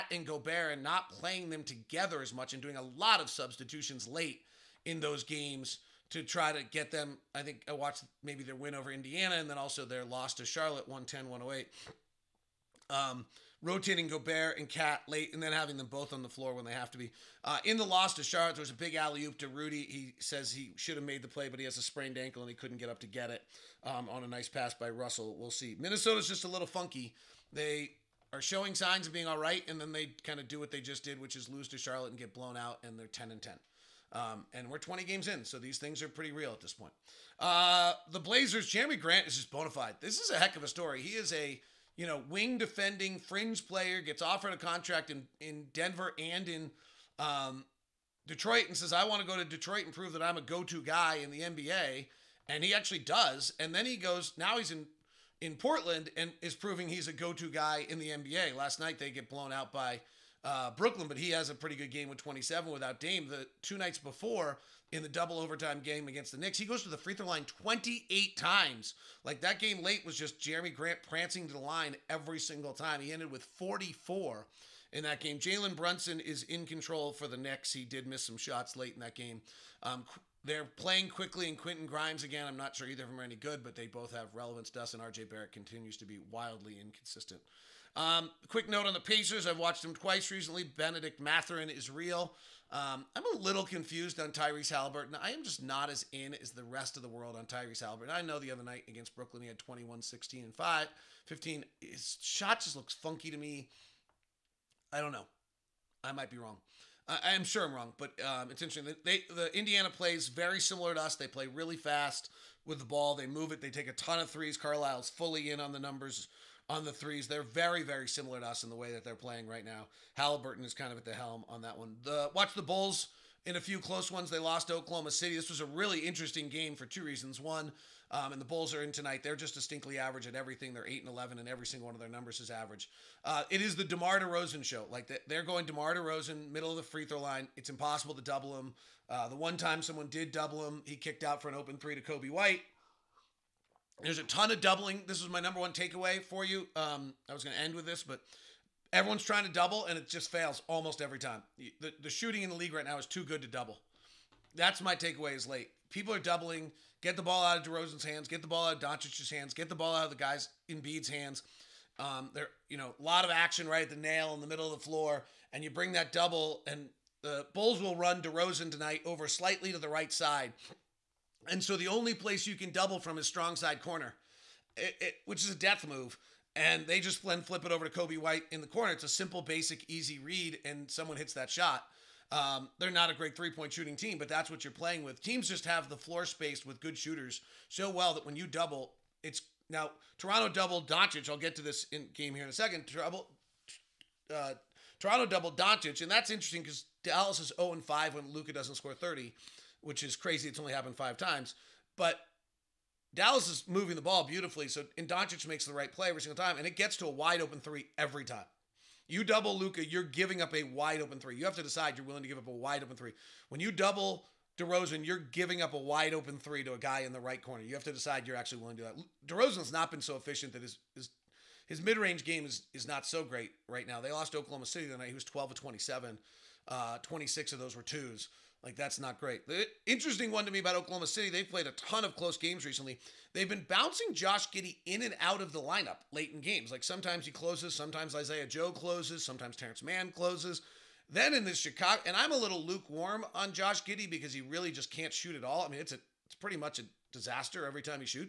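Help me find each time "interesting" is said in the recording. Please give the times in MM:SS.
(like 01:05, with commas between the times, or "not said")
01:48, 02:05, 03:16, 03:49.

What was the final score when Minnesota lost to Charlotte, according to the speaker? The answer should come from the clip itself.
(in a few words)
110-108.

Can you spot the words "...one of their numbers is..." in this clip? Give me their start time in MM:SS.
02:11.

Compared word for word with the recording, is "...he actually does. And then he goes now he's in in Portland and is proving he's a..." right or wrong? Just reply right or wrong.
right.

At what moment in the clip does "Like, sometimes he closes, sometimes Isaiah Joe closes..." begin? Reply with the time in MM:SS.
03:56.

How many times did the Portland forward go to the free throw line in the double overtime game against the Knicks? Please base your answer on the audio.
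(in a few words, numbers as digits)
28.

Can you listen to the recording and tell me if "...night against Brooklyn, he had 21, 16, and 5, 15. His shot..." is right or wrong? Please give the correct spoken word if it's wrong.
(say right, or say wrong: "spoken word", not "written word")
right.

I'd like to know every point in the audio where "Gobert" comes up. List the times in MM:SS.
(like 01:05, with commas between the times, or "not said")
00:00, 00:14.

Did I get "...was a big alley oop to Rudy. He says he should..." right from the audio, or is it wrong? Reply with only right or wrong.
right.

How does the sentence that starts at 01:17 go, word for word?
He did miss some shots late in that game.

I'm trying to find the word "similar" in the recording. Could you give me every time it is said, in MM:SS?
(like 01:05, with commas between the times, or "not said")
01:50, 01:58.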